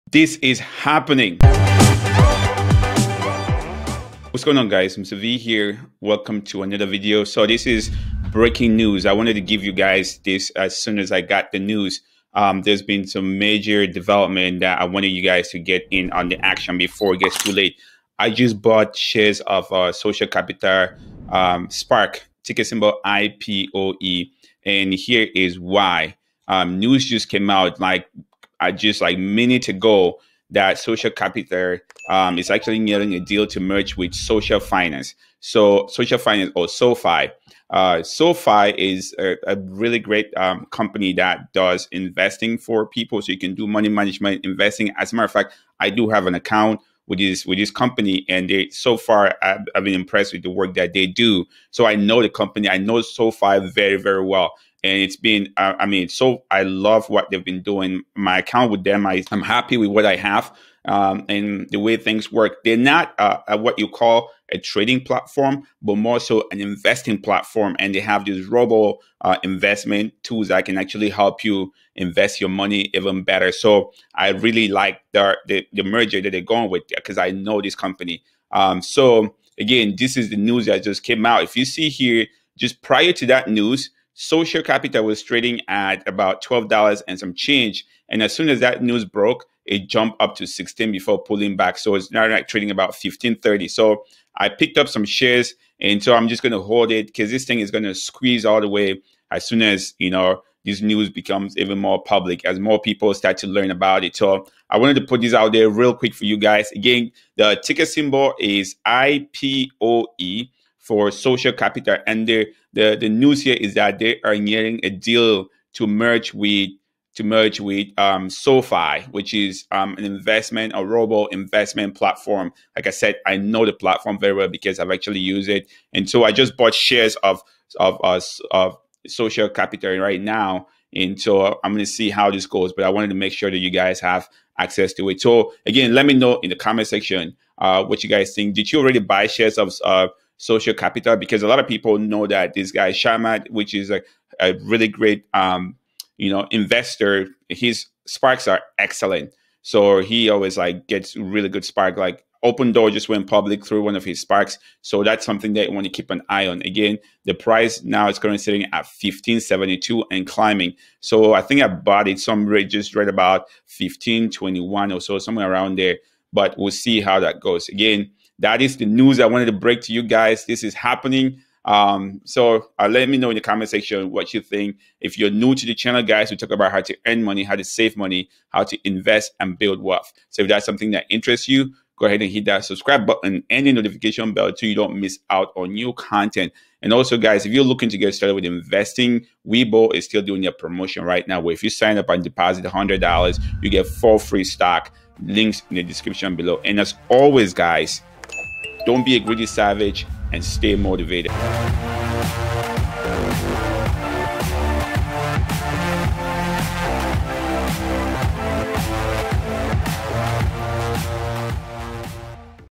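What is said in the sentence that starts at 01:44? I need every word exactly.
So I wanted to put this out there real quick for you guys.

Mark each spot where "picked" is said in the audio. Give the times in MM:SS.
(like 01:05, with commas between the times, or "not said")
01:34.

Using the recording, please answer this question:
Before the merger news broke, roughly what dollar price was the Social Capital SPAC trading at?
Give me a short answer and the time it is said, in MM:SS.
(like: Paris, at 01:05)
$12, at 01:26.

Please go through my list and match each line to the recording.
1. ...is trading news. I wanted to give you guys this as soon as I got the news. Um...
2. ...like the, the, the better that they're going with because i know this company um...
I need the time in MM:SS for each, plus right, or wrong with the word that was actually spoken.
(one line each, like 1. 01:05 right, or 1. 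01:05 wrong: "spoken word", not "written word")
1. 00:07 wrong: "breaking", not "trading"
2. 01:14 wrong: "merger", not "better".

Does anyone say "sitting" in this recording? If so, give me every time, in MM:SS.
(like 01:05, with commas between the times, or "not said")
02:38.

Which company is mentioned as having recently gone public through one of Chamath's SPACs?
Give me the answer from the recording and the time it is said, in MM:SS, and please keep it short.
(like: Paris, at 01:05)
Opendoor, at 02:32.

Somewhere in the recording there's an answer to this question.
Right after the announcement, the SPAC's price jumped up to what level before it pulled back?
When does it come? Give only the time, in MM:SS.
01:30.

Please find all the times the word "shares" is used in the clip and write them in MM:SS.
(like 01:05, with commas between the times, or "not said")
00:18, 01:35, 02:06, 02:19.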